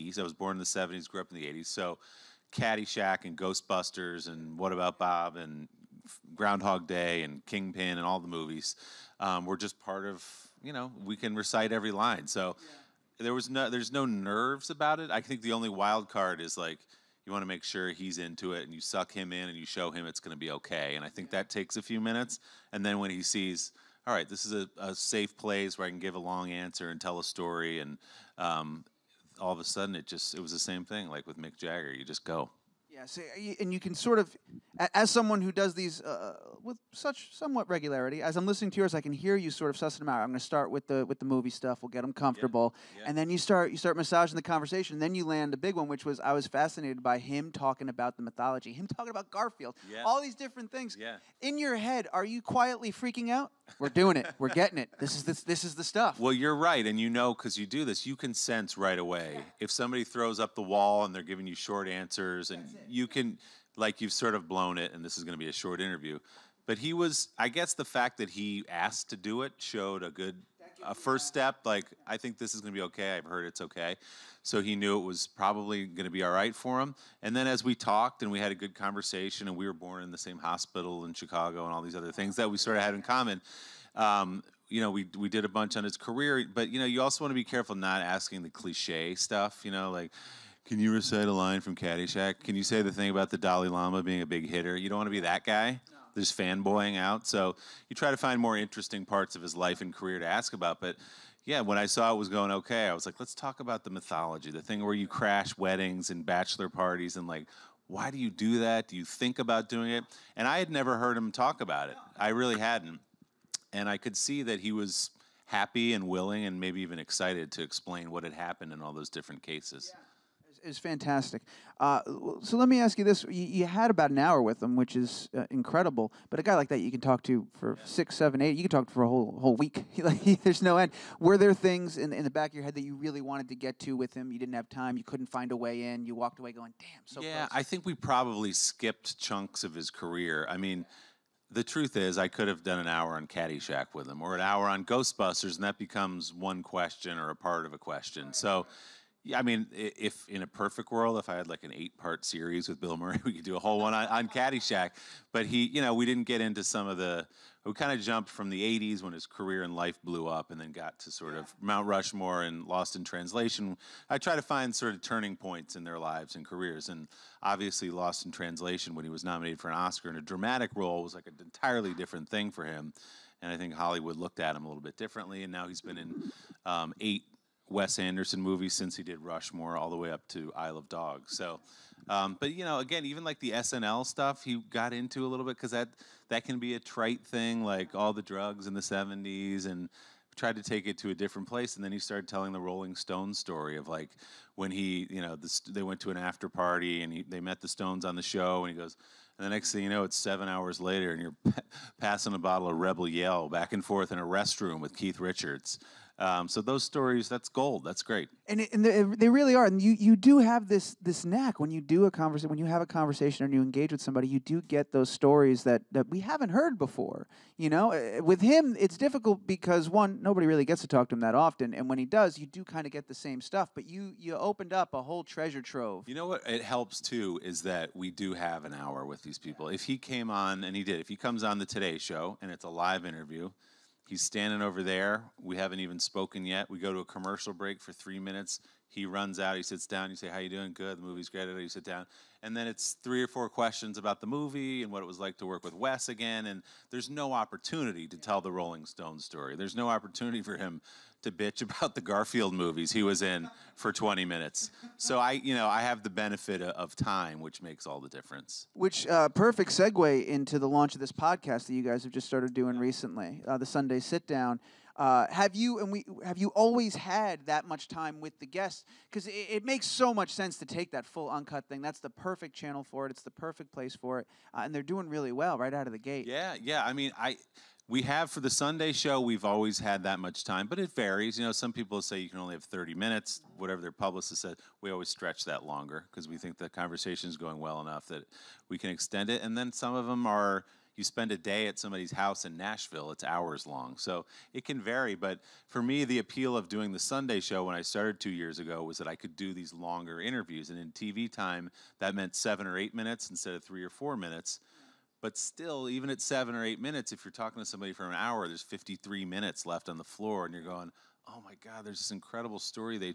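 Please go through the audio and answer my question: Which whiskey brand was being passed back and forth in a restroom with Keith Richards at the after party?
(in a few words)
Rebel Yell.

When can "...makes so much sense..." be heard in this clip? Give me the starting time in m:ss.
4:29.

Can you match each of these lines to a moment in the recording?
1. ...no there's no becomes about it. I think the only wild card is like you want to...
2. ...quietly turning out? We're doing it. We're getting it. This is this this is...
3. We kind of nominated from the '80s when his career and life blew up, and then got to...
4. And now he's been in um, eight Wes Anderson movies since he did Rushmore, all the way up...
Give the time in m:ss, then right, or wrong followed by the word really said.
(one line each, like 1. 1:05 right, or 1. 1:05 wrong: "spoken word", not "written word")
1. 0:13 wrong: "nerves", not "becomes"
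2. 0:52 wrong: "freaking", not "turning"
3. 2:37 wrong: "jumped", not "nominated"
4. 2:55 right.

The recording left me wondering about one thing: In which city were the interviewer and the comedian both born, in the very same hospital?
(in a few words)
Chicago.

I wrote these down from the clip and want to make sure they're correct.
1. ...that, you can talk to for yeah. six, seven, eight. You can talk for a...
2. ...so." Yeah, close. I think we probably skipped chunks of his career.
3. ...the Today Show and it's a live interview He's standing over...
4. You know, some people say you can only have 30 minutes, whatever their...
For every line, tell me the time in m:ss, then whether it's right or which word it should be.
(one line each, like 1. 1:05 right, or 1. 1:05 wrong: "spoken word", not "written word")
1. 2:06 right
2. 2:17 right
3. 3:51 right
4. 4:41 right.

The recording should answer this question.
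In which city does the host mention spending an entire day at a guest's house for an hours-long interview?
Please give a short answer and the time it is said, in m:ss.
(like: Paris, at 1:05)
Nashville, at 4:52.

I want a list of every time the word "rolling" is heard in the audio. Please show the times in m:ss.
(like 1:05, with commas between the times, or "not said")
3:12, 4:08.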